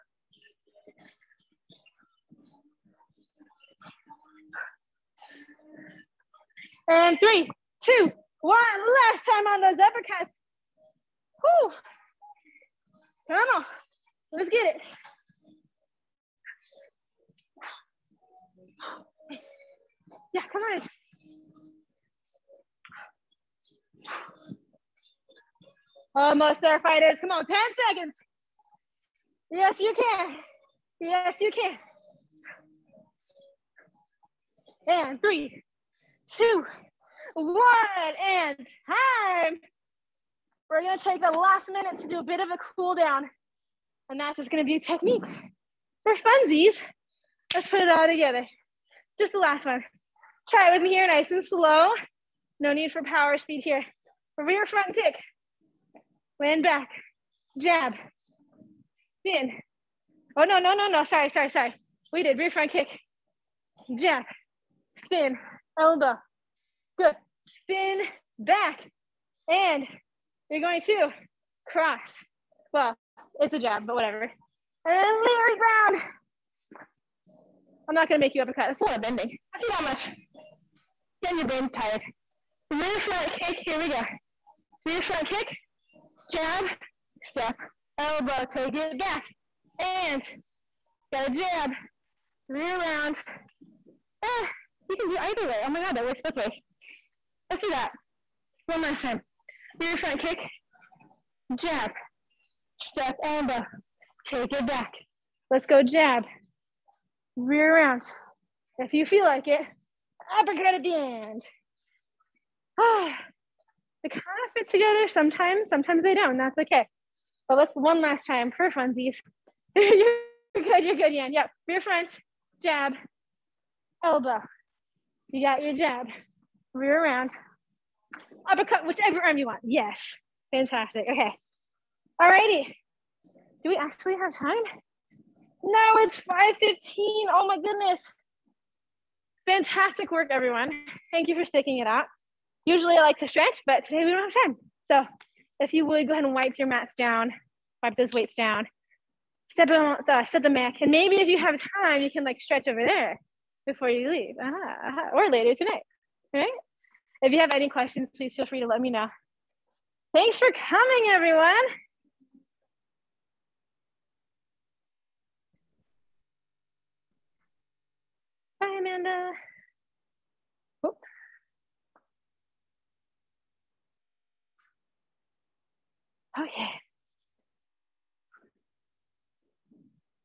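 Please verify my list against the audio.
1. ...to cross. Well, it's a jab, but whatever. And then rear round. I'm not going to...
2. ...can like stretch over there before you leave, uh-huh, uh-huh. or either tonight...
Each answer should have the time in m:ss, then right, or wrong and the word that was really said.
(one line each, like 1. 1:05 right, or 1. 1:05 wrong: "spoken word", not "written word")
1. 1:10 right
2. 2:32 wrong: "later", not "either".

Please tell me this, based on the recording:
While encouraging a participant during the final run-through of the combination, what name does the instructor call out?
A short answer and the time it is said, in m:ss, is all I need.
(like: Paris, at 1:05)
Yan, at 2:01.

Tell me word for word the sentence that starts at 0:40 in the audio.
We're gonna take the last minute to do a bit of a cool down.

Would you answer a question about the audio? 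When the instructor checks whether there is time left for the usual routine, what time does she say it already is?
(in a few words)
5:15.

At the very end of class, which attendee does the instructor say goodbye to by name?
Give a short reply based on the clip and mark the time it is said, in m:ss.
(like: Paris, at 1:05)
Amanda, at 2:48.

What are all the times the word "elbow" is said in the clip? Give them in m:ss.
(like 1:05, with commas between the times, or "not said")
1:05, 1:28, 1:43, 2:04.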